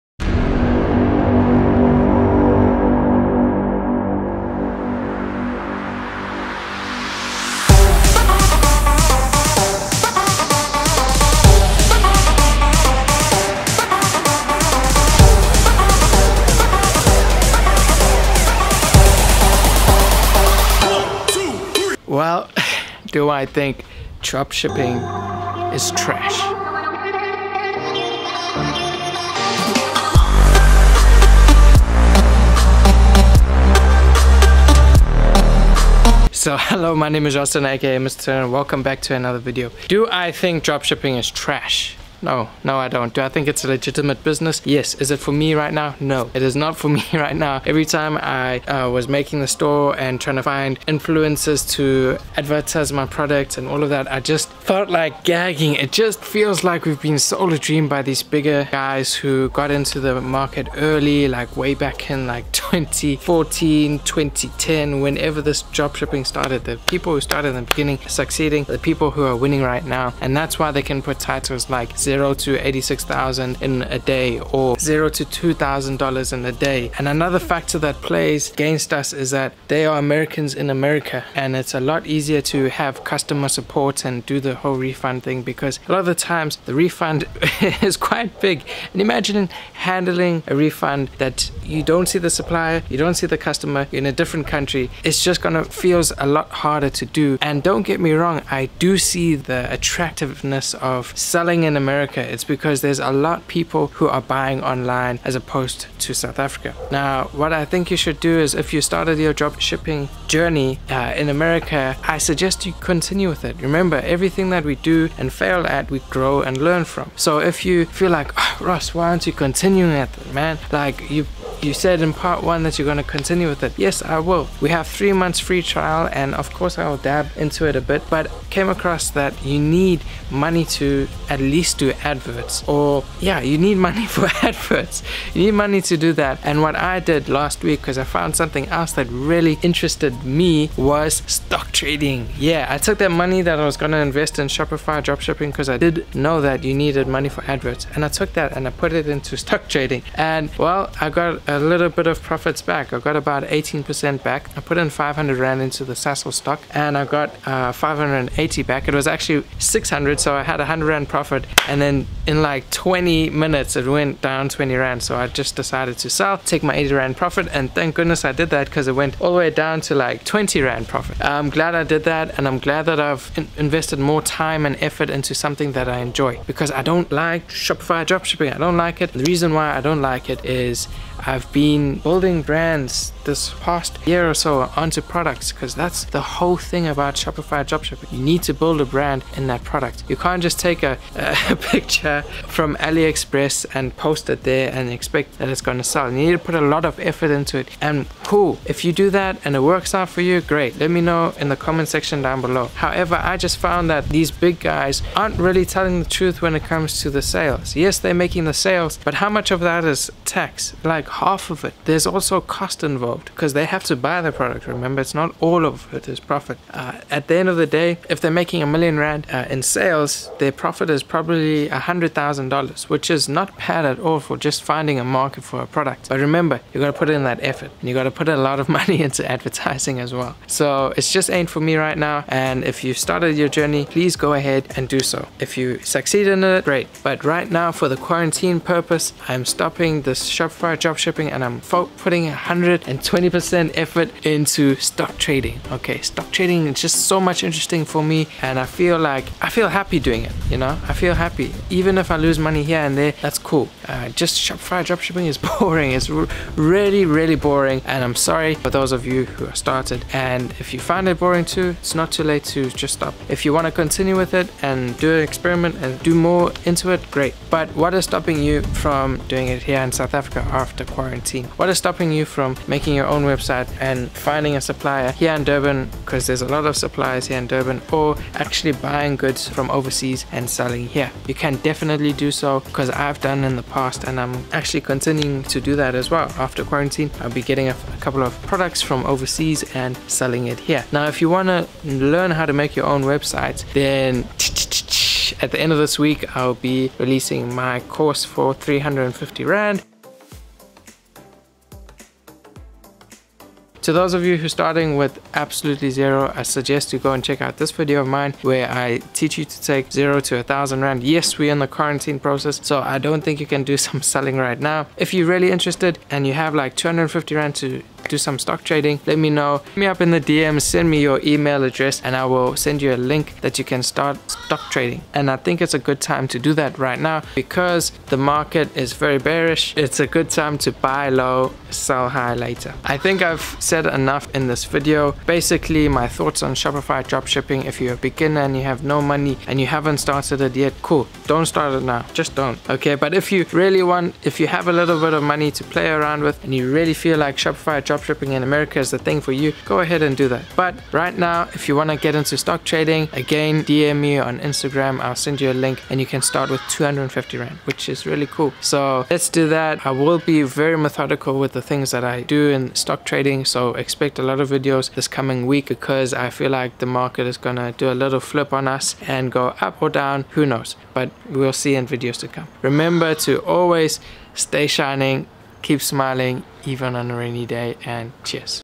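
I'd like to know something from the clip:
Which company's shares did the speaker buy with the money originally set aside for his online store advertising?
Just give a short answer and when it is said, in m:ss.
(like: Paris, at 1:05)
Sasol, at 2:35.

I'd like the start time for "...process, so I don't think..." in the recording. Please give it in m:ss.
5:12.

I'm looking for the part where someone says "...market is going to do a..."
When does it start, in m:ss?
6:06.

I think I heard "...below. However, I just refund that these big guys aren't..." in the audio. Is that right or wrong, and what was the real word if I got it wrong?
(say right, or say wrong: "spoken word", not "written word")
wrong: "found", not "refund".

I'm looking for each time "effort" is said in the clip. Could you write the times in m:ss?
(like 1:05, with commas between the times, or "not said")
2:54, 3:16, 3:47, 4:03.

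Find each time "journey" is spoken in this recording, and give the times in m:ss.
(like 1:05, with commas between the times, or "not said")
1:50, 3:53.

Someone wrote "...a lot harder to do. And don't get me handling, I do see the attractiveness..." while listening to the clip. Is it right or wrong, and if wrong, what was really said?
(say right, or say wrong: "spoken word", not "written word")
wrong: "wrong", not "handling".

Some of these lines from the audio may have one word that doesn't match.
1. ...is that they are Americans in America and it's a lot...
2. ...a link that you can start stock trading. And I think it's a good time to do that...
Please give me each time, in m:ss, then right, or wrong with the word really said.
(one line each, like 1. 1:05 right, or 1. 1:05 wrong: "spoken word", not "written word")
1. 1:19 right
2. 5:22 right.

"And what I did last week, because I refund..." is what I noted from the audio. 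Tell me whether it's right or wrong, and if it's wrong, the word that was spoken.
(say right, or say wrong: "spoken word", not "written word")
wrong: "found", not "refund".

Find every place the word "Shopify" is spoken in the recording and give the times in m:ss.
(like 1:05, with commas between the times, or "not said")
2:24, 2:57, 3:07, 4:00, 4:14, 5:36, 5:47.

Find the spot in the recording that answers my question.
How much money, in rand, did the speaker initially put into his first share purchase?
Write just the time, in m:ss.
2:34.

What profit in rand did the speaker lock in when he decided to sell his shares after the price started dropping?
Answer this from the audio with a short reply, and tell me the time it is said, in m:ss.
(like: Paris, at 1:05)
80 rand, at 2:46.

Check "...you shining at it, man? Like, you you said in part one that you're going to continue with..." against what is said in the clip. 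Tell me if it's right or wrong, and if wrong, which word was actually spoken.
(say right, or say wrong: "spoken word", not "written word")
wrong: "continuing", not "shining".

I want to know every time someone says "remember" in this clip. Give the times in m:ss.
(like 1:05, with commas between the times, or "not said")
1:53, 3:34, 3:46, 6:12.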